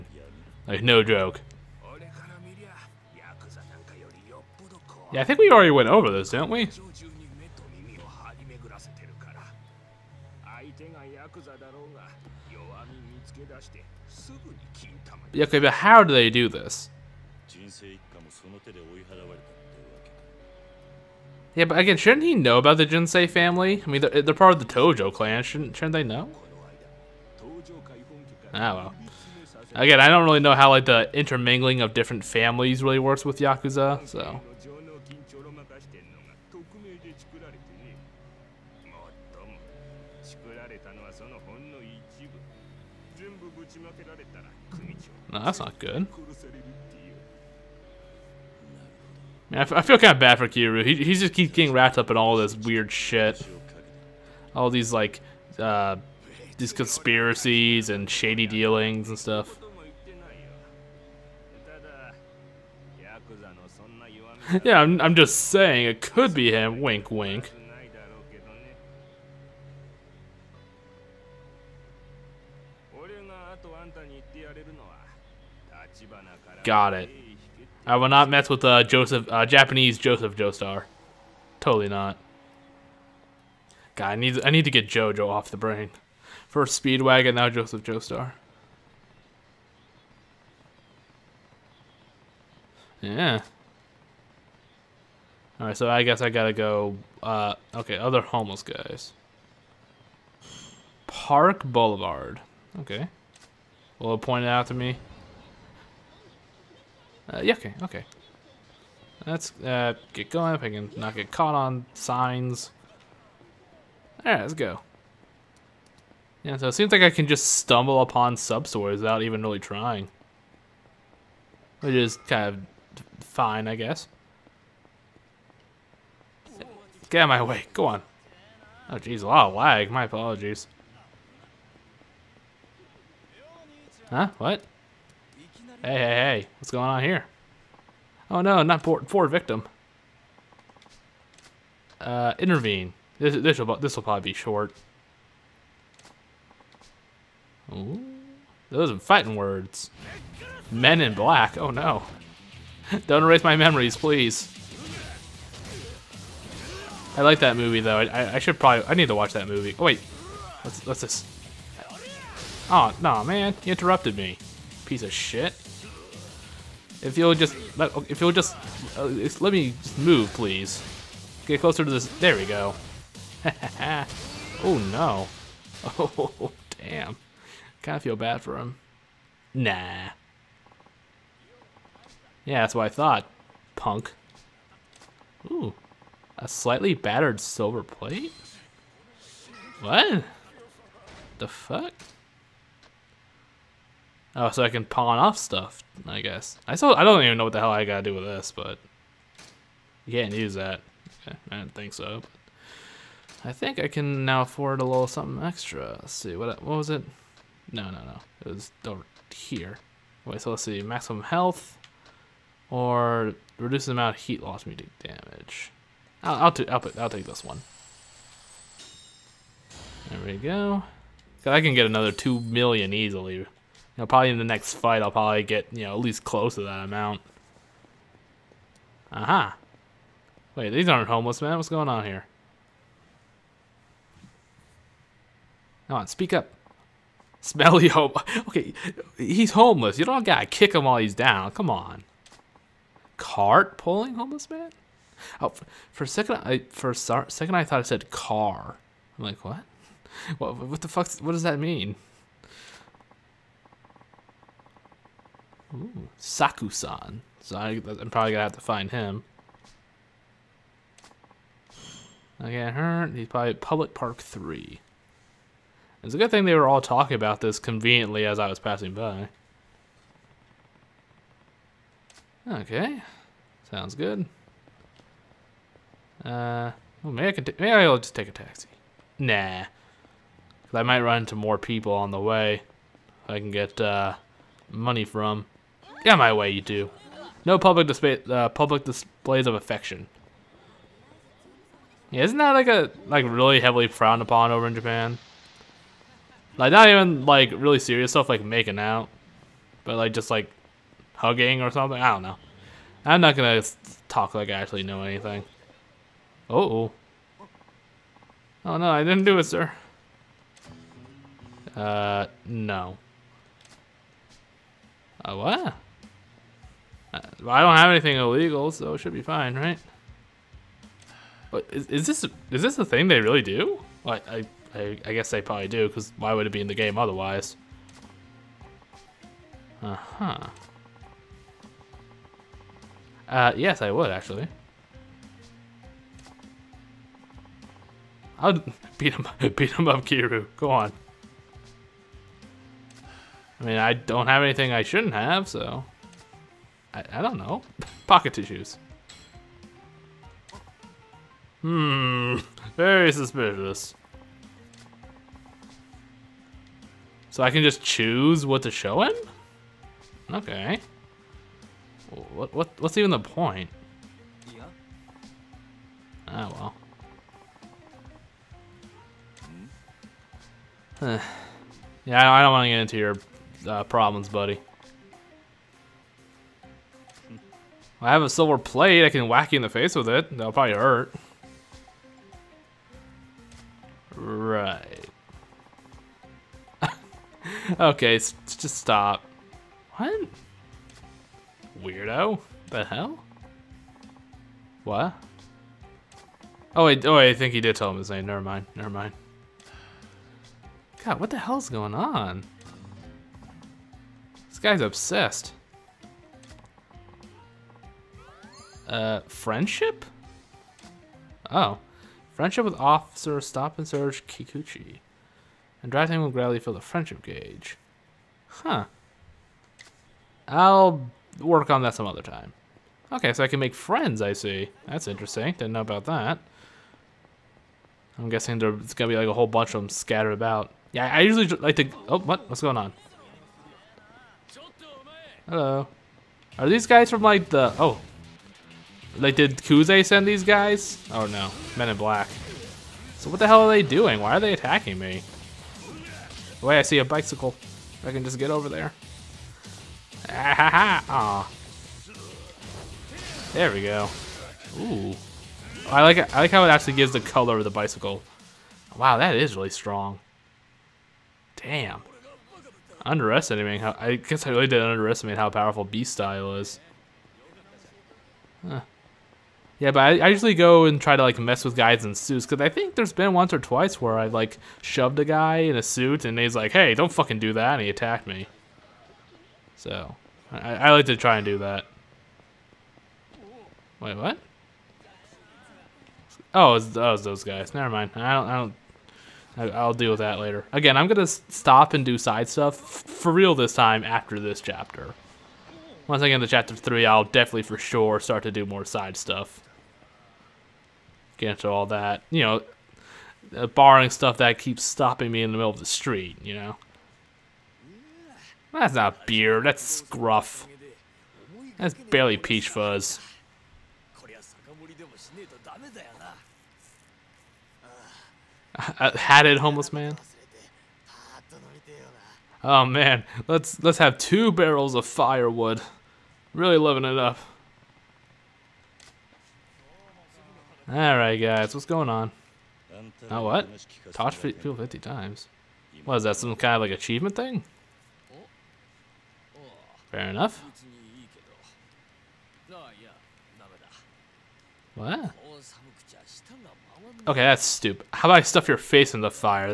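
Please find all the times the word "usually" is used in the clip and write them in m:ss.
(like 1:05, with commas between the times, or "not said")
7:11, 7:50.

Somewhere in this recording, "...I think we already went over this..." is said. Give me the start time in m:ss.
0:05.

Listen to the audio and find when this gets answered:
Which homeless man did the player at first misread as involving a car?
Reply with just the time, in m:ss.
4:03.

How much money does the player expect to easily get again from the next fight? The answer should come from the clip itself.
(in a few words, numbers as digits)
2 million.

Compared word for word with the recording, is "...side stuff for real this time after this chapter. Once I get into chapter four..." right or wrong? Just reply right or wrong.
wrong.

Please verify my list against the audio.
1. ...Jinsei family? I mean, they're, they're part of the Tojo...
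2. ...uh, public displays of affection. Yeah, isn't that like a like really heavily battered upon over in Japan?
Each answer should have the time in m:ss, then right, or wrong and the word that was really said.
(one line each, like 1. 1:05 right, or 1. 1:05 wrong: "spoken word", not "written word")
1. 0:22 right
2. 4:48 wrong: "frowned", not "battered".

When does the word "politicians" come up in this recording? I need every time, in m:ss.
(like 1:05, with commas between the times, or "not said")
not said.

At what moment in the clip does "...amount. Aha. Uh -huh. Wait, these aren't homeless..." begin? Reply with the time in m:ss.
3:46.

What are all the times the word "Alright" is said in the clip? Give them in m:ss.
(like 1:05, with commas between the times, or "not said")
1:35, 1:54, 8:50.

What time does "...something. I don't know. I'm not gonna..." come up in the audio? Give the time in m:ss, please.
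5:01.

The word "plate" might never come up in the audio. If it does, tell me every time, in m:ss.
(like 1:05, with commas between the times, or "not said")
3:07, 6:18.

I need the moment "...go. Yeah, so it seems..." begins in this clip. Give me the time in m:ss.
1:54.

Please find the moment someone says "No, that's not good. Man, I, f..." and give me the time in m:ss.
0:45.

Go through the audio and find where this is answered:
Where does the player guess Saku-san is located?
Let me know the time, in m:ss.
4:23.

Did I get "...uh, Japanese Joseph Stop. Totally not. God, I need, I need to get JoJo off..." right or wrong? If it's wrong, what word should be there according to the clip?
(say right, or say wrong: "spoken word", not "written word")
wrong: "Joestar", not "Stop".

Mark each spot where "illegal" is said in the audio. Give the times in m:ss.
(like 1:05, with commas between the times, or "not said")
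5:18.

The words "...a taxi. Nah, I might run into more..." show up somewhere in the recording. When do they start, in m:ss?
4:38.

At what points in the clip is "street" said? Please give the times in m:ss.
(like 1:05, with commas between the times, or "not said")
8:25.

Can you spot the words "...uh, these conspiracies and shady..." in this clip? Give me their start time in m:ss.
0:55.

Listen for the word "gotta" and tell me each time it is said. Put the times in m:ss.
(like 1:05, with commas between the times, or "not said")
1:36, 3:17, 4:00.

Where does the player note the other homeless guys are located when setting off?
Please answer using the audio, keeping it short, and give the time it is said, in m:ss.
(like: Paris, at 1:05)
Park Boulevard, at 1:41.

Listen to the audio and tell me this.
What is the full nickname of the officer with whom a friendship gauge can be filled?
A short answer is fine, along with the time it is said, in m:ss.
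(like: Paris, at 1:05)
Officer Stop and Search Kikuchi, at 6:52.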